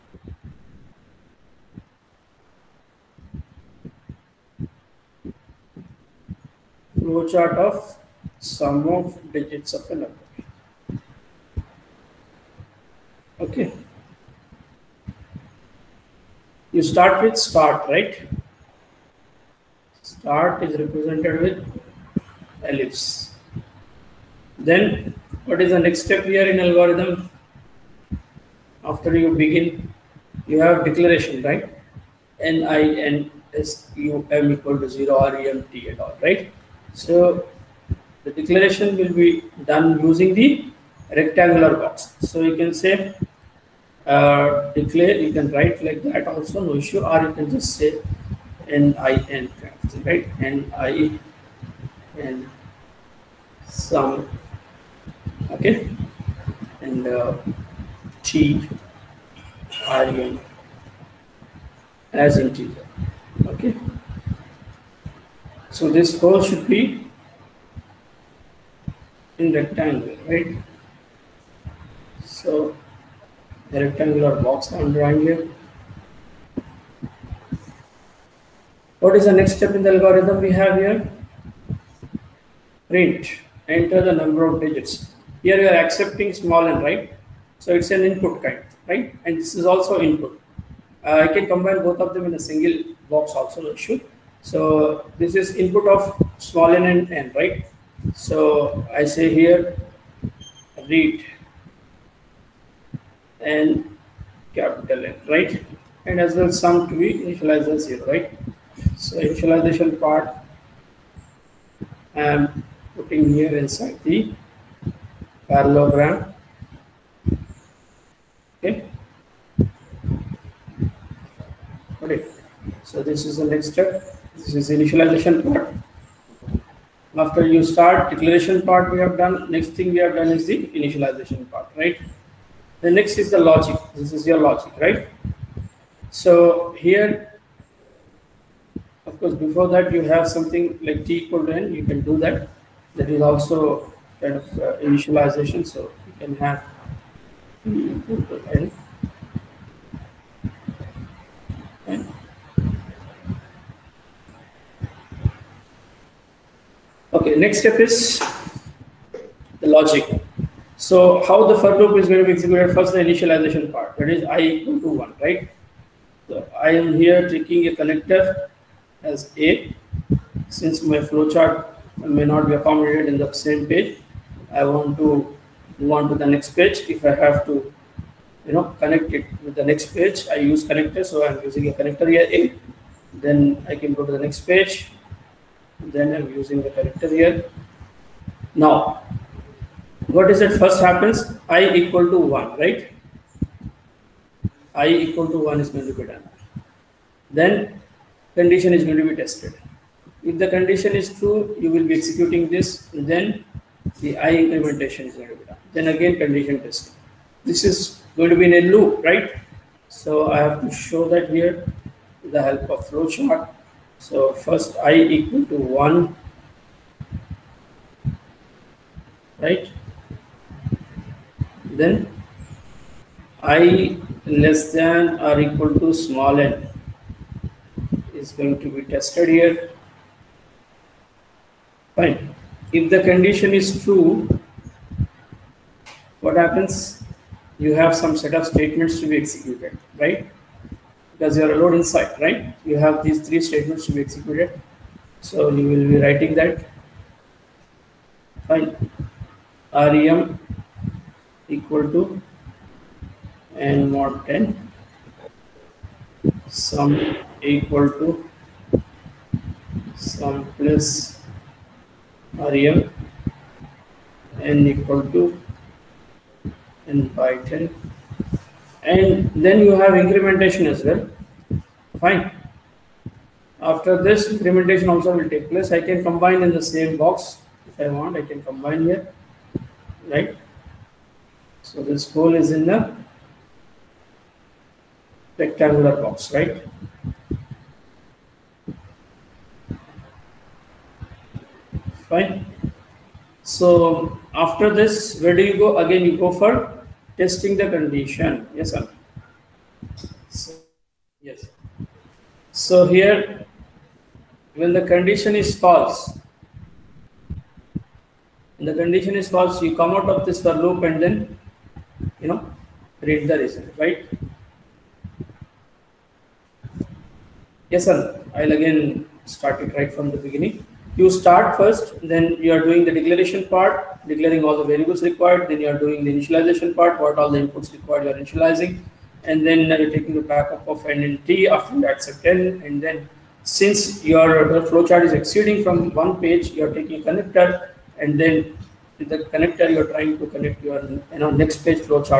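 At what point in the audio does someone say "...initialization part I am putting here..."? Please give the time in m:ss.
1:49.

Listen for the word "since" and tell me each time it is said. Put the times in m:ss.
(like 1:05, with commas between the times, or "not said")
2:50, 5:33.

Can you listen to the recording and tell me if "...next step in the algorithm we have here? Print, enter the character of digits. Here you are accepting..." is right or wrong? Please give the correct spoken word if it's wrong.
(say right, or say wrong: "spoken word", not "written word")
wrong: "number", not "character".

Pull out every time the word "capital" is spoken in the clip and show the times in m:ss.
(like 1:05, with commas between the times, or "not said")
1:44.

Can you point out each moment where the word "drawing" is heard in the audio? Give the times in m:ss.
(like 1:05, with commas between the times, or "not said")
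1:14.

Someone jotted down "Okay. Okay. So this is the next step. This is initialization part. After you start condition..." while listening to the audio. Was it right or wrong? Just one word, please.
wrong.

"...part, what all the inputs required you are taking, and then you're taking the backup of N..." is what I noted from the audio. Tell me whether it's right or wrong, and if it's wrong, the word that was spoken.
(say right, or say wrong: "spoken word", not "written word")
wrong: "initializing", not "taking".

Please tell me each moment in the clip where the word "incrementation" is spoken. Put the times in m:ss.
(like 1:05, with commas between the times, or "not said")
4:30, 4:34.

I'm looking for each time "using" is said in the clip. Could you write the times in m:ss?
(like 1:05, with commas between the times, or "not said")
0:40, 3:01, 3:06.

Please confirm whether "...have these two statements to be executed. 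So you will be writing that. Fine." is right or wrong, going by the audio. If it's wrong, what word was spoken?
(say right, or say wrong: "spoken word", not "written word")
wrong: "three", not "two".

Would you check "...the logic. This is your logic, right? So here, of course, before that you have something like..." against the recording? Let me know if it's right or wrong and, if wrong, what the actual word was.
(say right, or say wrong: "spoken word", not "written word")
right.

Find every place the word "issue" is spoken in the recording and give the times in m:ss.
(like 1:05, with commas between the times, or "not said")
0:46.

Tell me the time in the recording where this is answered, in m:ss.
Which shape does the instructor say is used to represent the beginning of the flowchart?
0:22.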